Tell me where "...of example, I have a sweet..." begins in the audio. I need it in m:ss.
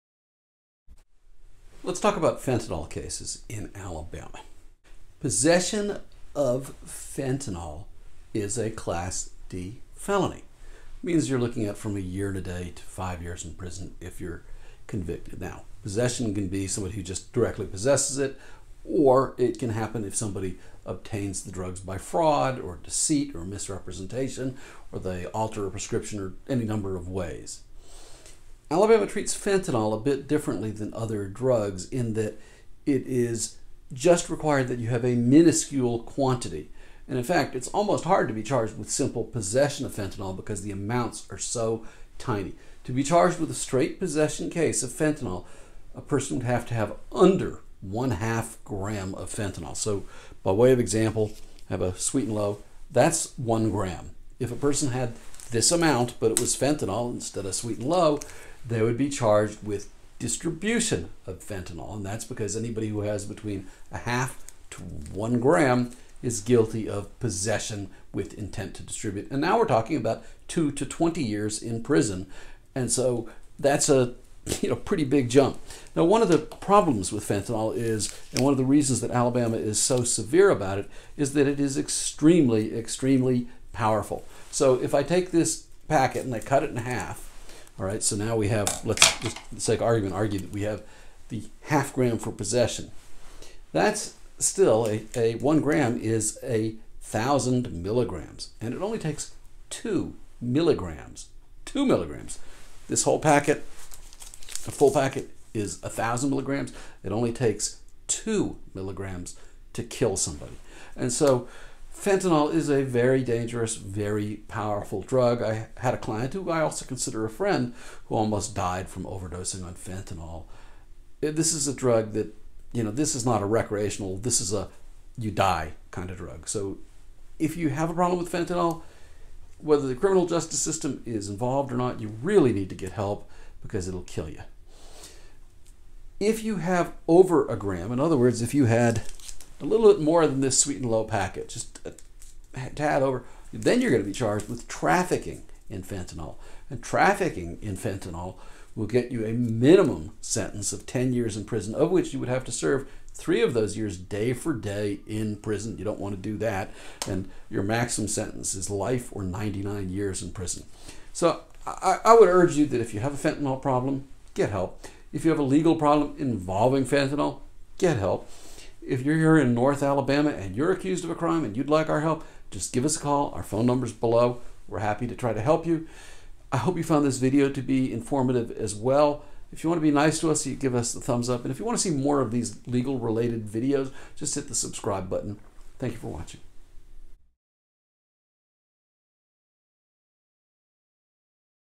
0:50.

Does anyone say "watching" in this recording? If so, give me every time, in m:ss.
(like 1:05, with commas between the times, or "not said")
3:06.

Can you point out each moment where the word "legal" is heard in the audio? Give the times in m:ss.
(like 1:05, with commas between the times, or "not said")
2:45, 3:02.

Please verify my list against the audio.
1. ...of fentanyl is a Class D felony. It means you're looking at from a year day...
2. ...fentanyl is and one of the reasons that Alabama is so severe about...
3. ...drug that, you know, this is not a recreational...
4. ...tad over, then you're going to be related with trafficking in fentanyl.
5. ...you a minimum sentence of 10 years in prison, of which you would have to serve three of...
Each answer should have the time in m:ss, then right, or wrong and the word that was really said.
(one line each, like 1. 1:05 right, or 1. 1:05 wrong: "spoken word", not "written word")
1. 0:06 right
2. 1:17 right
3. 2:01 right
4. 2:22 wrong: "charged", not "related"
5. 2:29 right.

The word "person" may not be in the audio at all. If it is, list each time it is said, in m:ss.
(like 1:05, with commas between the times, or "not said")
0:45, 0:54.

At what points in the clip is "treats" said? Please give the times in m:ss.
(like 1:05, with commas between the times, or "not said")
0:29.